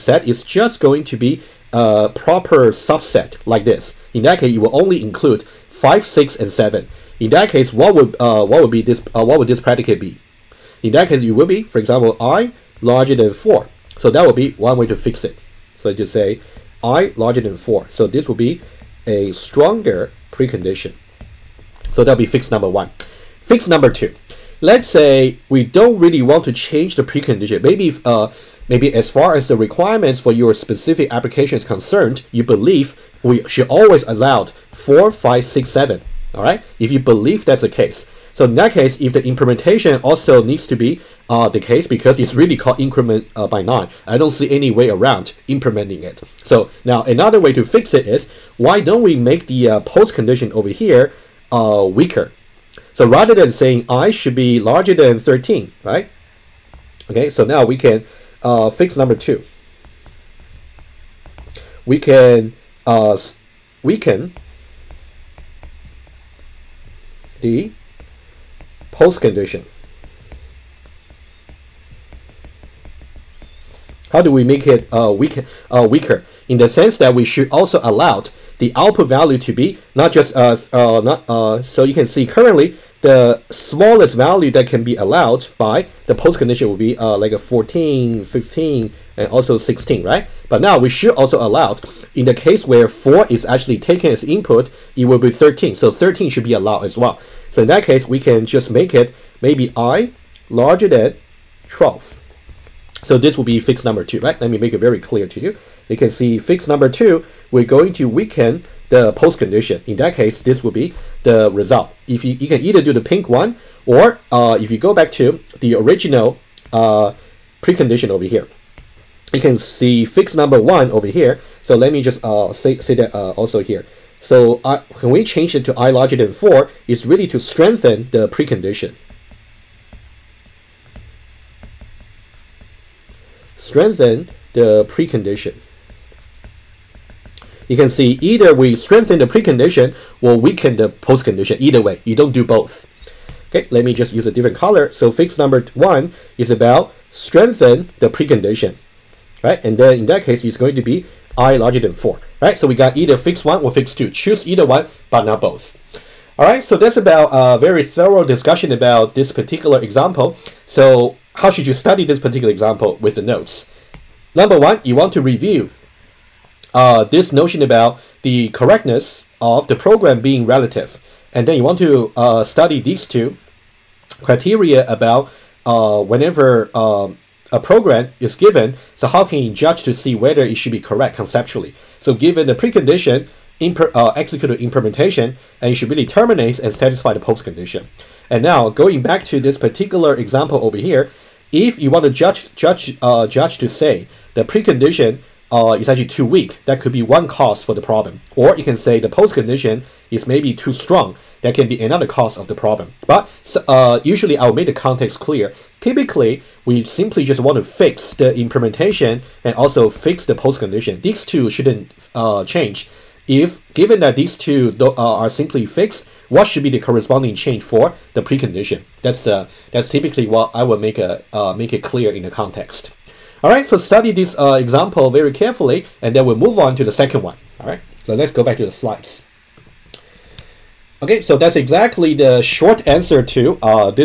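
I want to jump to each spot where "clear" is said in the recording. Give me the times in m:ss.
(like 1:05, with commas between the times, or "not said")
1:44, 3:25, 3:41.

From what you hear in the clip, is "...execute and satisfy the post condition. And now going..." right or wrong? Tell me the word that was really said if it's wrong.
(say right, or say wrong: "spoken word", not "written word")
wrong: "terminate", not "execute".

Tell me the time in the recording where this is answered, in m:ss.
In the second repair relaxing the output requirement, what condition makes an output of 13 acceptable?
1:39.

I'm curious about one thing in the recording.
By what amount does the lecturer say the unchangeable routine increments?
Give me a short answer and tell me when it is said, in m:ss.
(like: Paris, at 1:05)
9, at 0:43.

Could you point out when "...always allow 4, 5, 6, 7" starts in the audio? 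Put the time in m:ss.
0:33.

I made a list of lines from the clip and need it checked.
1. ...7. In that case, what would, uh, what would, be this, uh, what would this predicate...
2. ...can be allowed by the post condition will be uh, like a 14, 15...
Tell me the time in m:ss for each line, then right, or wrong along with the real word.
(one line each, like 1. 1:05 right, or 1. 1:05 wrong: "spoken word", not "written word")
1. 0:06 right
2. 1:24 right.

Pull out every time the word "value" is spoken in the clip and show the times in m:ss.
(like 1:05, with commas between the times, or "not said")
1:19, 1:24.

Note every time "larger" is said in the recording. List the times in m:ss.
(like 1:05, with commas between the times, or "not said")
0:12, 0:17, 0:54, 1:40, 2:05, 2:31.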